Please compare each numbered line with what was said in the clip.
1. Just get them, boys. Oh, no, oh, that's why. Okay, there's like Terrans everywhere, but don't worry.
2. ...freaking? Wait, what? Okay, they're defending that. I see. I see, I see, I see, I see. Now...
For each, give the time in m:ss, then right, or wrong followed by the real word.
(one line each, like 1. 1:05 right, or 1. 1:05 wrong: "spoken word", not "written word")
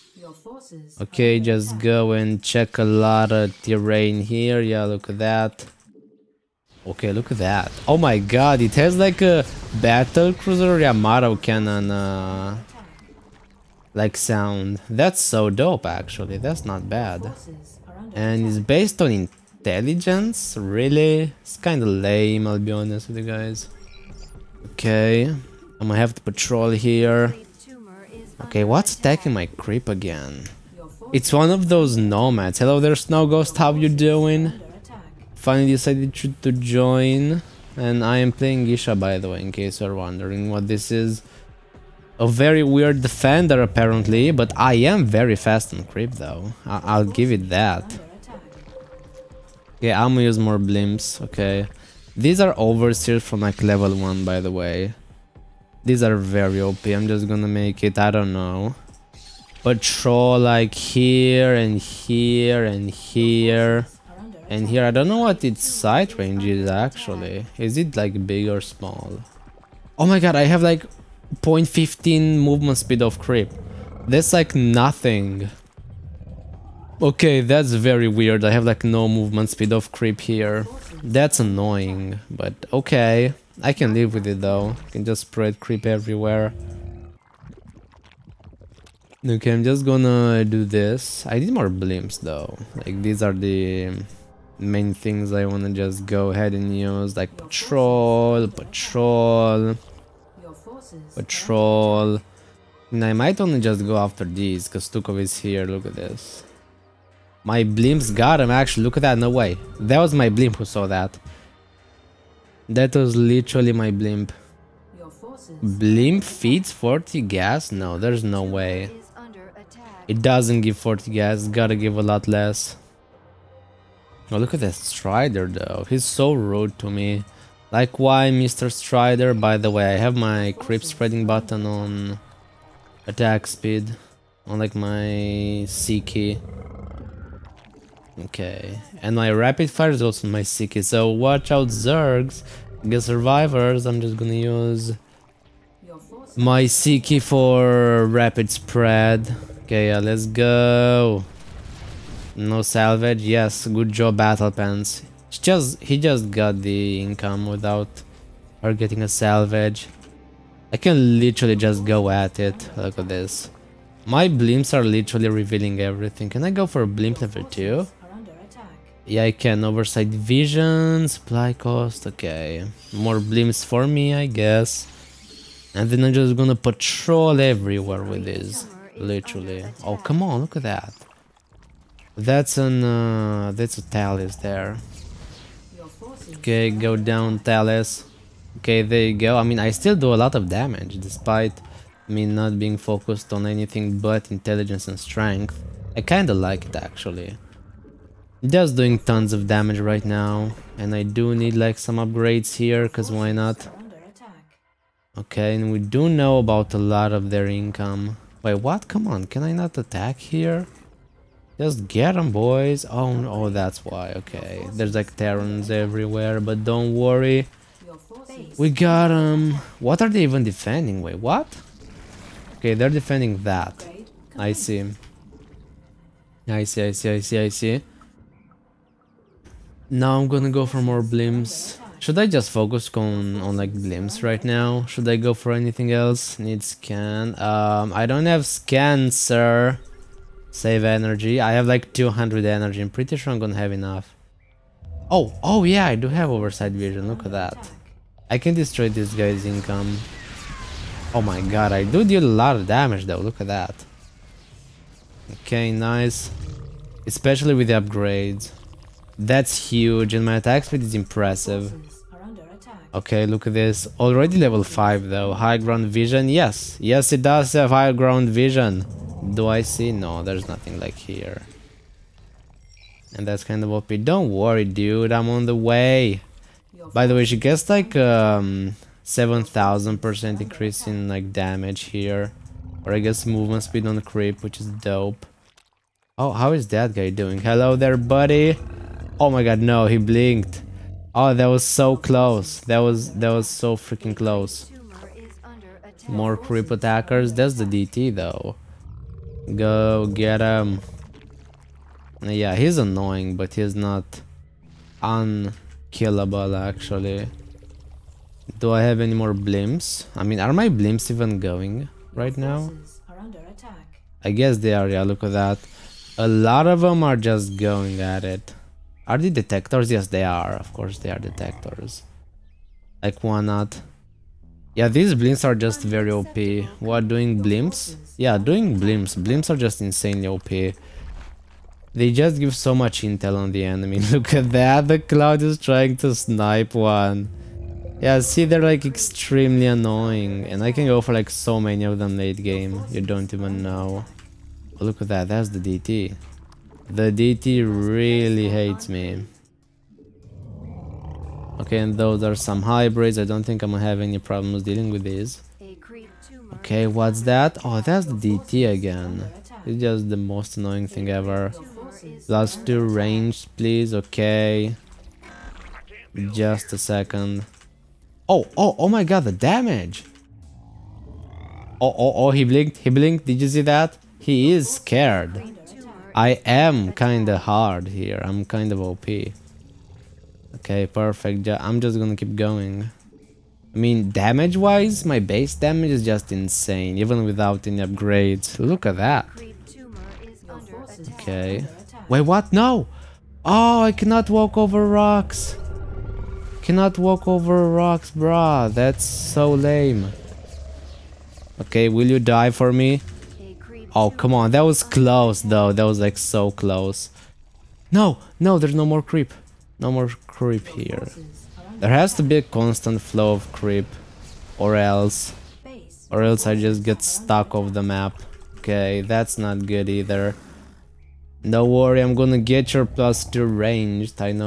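1. 3:31 right
2. 3:40 wrong: "defending", not "freaking".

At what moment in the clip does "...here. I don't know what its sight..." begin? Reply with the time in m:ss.
1:04.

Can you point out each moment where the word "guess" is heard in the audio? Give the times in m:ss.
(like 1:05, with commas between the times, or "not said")
2:54, 4:42, 5:14.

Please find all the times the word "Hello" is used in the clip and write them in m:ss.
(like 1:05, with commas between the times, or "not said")
0:32, 4:47.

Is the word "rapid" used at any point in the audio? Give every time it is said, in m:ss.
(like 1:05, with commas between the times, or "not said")
2:19, 2:28.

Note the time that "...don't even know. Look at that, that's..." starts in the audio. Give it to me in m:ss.
5:43.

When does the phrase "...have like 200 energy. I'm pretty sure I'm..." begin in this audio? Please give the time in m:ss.
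4:01.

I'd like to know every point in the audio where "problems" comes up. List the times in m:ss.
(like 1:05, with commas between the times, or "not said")
5:54.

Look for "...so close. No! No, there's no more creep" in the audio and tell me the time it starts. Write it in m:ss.
6:46.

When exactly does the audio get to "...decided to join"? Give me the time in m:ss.
0:35.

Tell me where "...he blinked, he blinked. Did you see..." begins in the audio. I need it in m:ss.
6:12.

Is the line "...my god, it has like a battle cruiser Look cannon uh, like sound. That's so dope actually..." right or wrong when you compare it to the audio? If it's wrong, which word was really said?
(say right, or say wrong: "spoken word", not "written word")
wrong: "Yamato", not "Look".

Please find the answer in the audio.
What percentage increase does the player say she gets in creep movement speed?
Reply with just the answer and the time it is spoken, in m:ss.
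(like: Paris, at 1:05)
7,000%, at 4:37.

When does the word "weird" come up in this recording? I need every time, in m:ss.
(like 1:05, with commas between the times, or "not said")
0:42, 1:18.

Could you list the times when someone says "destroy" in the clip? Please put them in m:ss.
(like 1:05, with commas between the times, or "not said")
4:08.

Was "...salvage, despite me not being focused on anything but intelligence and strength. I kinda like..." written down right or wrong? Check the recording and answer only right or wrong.
wrong.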